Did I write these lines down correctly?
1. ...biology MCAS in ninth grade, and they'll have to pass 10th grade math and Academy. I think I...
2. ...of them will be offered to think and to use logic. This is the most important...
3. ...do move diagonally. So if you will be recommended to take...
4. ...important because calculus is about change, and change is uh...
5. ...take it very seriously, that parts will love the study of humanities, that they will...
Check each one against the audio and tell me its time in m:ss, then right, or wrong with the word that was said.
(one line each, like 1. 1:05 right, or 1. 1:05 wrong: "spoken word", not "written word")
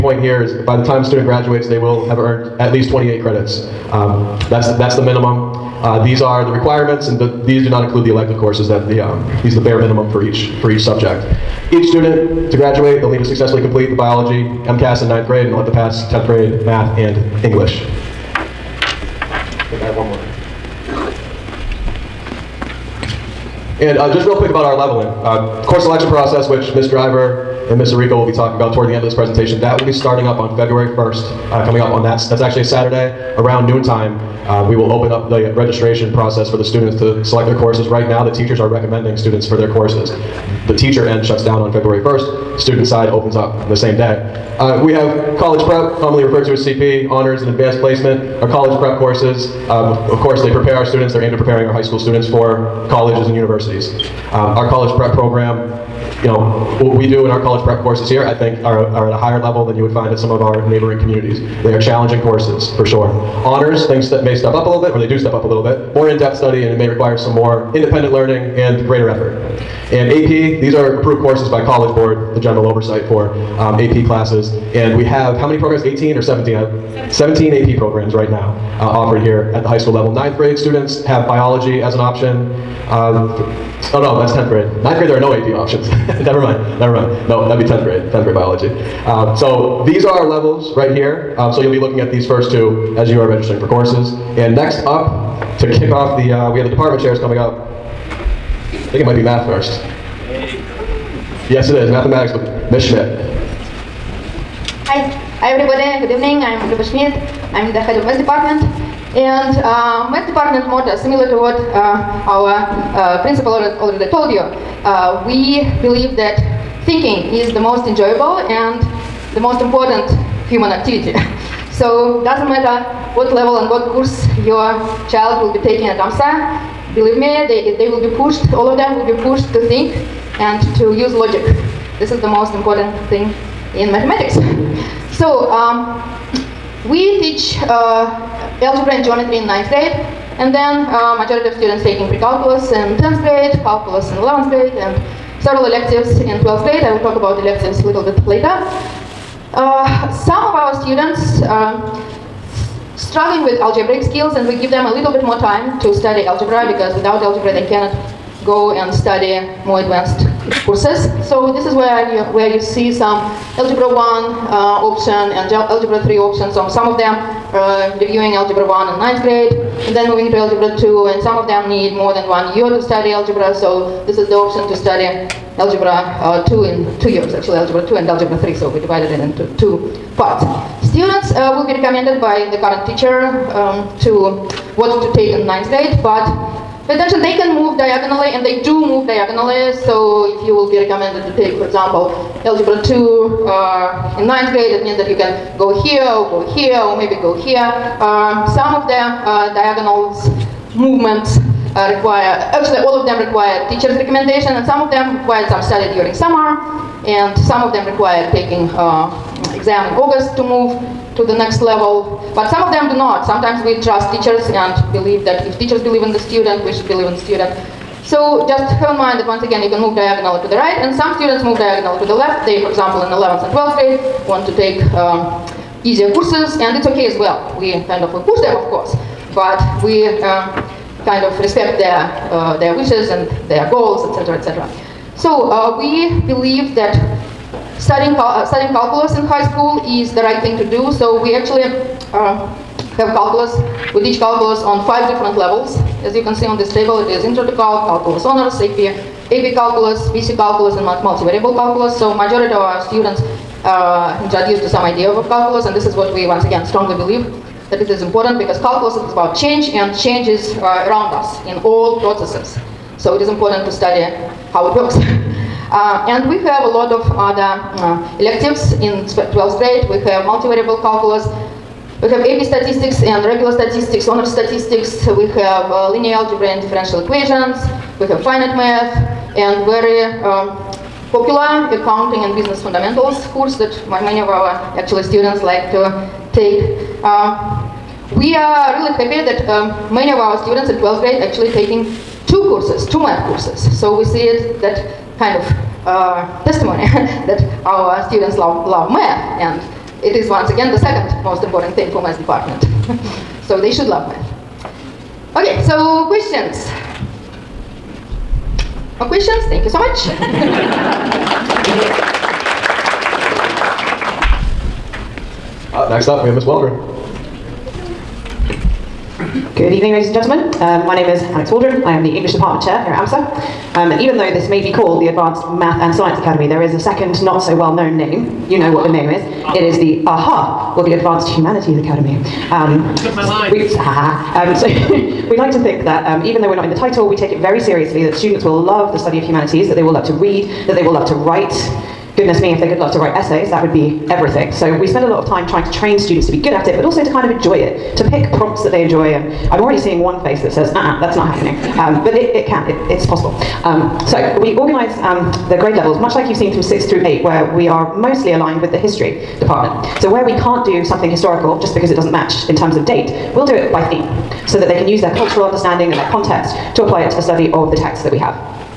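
1. 0:13 wrong: "English", not "Academy"
2. 2:08 wrong: "pushed", not "offered"
3. 3:08 right
4. 4:18 right
5. 5:37 wrong: "students", not "parts".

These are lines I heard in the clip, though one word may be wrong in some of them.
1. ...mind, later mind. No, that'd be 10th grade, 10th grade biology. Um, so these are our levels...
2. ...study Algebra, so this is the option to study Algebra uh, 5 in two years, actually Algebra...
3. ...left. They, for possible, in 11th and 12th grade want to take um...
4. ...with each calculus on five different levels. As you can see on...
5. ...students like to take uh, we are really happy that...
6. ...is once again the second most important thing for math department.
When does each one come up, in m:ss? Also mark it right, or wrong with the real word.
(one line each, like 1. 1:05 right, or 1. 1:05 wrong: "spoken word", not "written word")
1. 1:26 wrong: "never", not "later"
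2. 2:52 wrong: "2", not "5"
3. 3:42 wrong: "example", not "possible"
4. 4:03 right
5. 4:45 right
6. 5:00 right.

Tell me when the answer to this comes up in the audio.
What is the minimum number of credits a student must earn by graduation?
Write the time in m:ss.
0:02.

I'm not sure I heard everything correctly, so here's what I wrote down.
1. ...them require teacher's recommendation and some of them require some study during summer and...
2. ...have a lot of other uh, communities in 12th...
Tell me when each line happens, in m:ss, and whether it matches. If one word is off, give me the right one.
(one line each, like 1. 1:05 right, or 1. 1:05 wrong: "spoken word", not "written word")
1. 3:23 right
2. 4:26 wrong: "electives", not "communities".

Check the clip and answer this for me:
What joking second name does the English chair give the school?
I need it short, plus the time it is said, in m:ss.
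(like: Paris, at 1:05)
Advanced Humanities Academy, at 5:30.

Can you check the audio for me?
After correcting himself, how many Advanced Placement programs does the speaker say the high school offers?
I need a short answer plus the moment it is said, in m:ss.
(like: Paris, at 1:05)
17, at 1:17.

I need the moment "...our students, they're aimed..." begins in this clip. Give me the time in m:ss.
0:50.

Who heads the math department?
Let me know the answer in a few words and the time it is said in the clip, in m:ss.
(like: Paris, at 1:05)
Luba Schmidt, at 1:46.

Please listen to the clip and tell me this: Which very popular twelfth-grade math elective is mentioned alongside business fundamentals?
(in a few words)
accounting.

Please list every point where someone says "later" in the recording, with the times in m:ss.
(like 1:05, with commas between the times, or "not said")
2:28.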